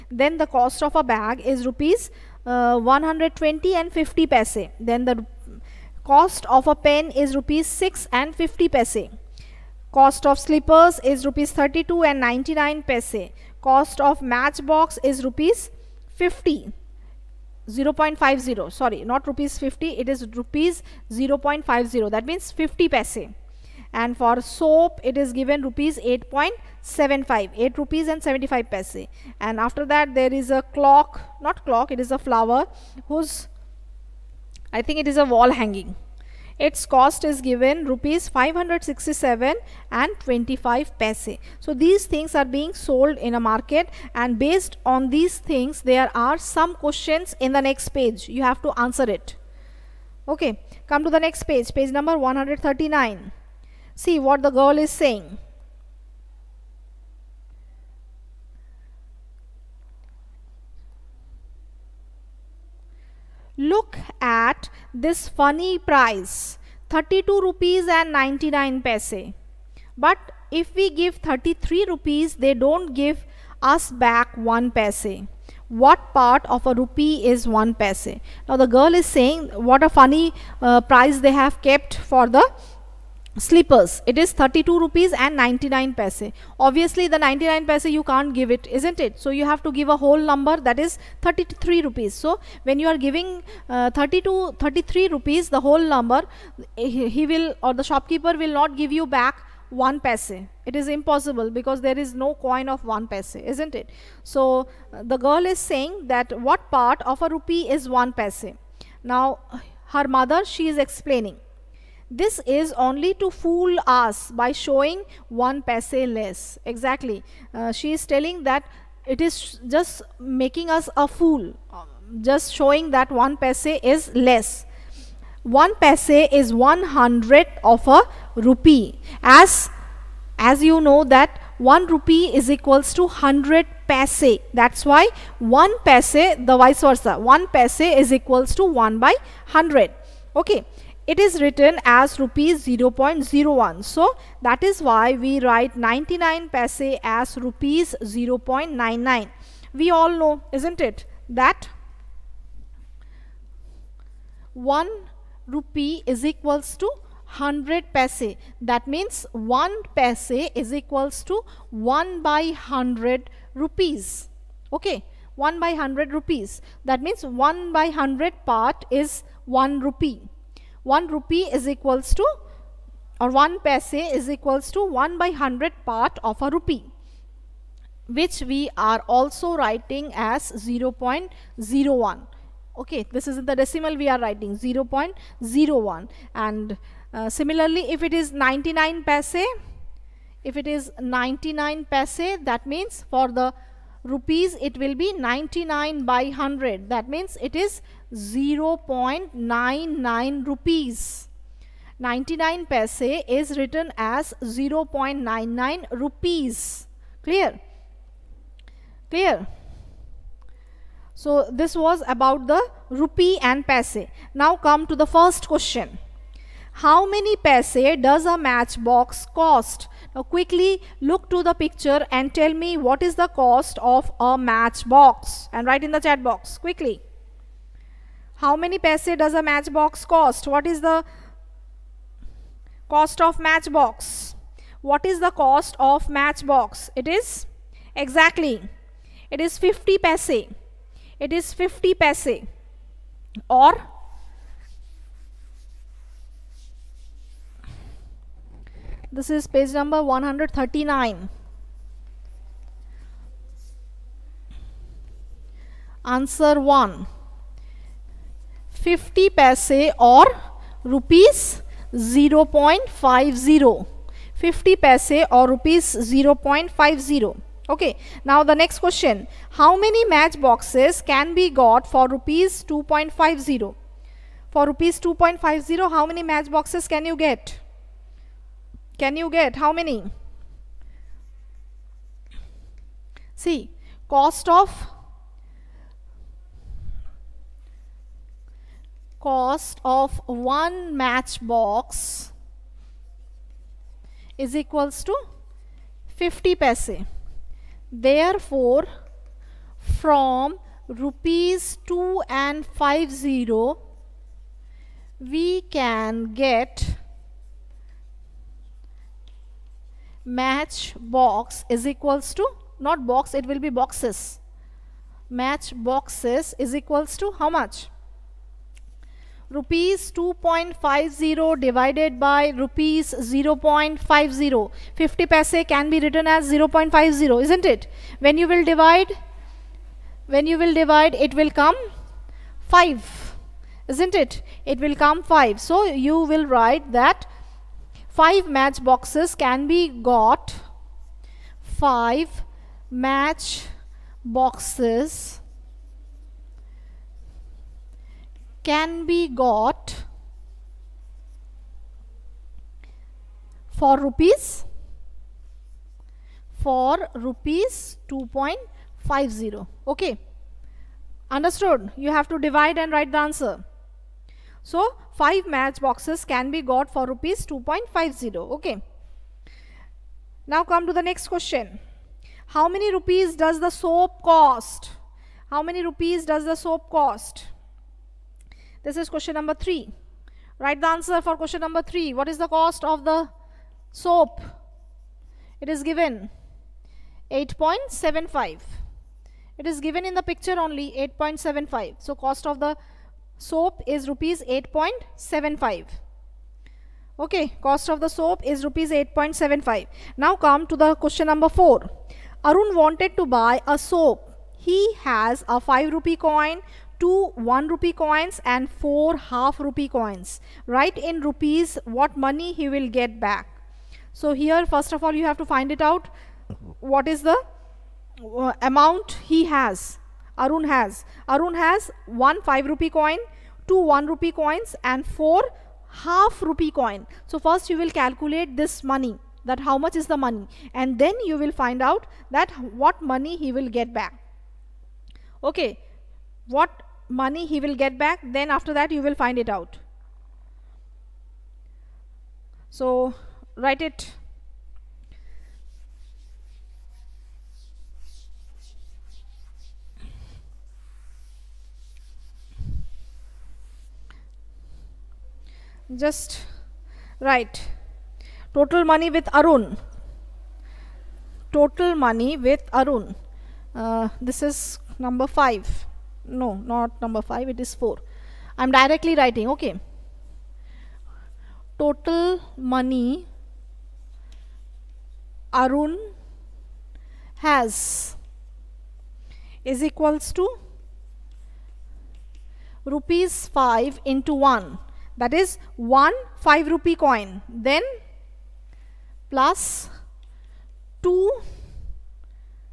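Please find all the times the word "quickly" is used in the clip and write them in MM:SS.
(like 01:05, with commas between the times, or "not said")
03:40, 03:46.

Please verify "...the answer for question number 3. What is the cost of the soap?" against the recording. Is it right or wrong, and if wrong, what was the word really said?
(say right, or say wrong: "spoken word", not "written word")
right.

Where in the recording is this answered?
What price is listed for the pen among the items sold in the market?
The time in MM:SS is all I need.
00:07.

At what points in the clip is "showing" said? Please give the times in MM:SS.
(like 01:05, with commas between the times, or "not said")
01:54, 02:02.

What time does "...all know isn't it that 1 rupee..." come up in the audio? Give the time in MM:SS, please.
02:29.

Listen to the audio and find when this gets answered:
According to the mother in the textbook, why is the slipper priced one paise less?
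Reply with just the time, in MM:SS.
01:53.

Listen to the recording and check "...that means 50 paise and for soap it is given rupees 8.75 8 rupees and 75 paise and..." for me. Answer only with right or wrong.
right.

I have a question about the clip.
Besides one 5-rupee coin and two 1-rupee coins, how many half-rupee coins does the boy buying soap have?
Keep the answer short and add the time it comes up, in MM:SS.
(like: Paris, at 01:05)
4, at 06:48.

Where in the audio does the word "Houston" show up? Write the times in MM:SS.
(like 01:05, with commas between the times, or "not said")
not said.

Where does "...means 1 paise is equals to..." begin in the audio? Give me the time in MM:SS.
02:38.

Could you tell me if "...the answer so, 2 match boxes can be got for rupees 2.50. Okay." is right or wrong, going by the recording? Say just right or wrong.
wrong.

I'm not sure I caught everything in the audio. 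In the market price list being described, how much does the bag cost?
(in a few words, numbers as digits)
Rs 120.50.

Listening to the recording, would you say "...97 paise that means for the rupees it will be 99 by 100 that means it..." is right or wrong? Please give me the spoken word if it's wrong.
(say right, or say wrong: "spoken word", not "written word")
wrong: "99", not "97".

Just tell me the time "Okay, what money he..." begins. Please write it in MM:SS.
07:15.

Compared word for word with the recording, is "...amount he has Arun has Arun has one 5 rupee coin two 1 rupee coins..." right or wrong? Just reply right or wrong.
right.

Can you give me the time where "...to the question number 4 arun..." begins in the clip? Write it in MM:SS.
06:40.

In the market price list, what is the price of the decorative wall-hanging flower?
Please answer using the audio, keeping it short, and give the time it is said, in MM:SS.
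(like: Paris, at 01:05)
Rs 567.25, at 00:37.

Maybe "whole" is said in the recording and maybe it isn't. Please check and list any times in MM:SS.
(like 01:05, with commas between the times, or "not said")
01:29, 01:35.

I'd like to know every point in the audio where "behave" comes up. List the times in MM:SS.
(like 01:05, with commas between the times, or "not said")
not said.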